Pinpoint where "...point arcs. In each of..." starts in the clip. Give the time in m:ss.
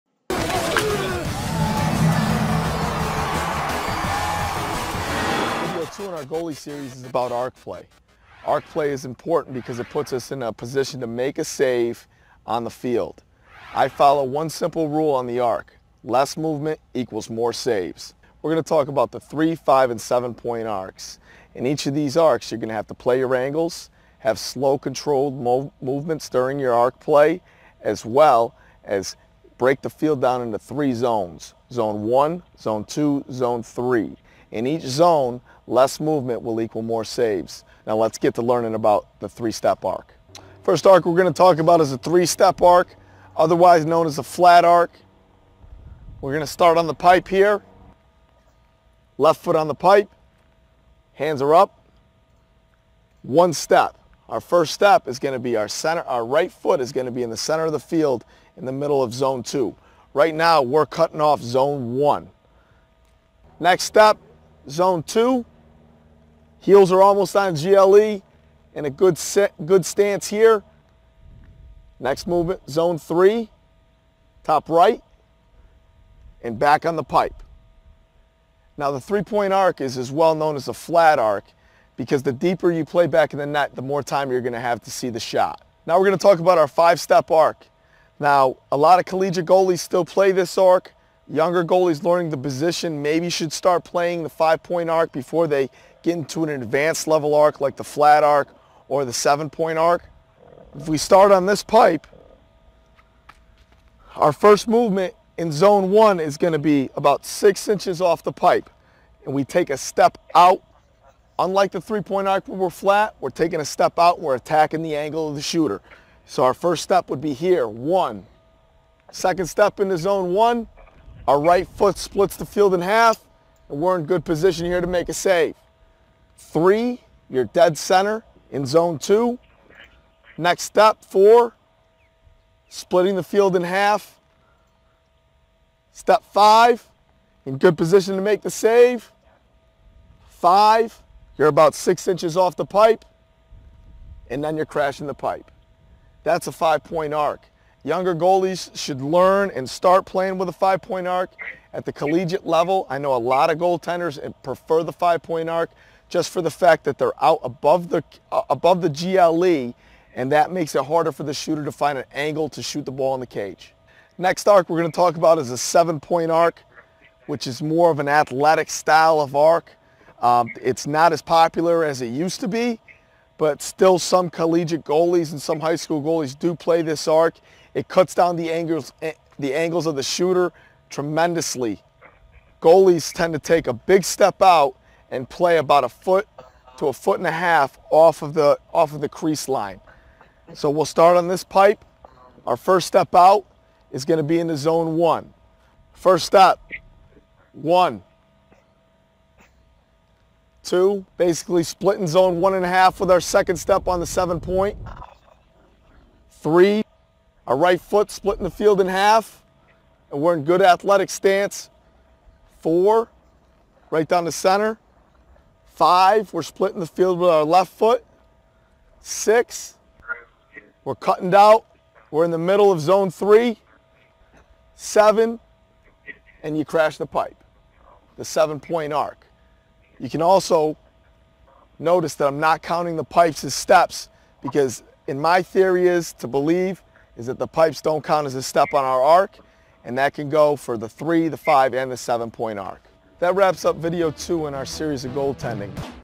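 0:20.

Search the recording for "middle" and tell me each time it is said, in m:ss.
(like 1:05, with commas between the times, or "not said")
0:58, 3:42.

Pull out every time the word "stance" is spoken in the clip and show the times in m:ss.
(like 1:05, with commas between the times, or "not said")
1:09, 3:31.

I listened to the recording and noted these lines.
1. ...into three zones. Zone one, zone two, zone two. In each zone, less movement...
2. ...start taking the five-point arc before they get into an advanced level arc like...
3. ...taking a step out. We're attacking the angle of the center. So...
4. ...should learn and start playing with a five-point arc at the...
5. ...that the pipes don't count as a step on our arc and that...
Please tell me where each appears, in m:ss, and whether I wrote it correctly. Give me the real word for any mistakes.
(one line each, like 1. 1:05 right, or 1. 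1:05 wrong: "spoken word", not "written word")
1. 0:30 wrong: "three", not "two"
2. 1:33 wrong: "playing", not "taking"
3. 1:53 wrong: "shooter", not "center"
4. 2:28 right
5. 3:57 right.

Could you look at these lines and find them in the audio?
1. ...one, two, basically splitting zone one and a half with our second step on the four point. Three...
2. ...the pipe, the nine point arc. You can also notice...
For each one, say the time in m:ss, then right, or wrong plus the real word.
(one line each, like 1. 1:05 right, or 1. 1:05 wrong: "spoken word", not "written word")
1. 3:17 wrong: "seven", not "four"
2. 3:46 wrong: "seven", not "nine".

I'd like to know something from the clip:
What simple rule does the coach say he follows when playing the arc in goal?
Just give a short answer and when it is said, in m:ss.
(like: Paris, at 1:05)
Less movement equals more saves, at 0:16.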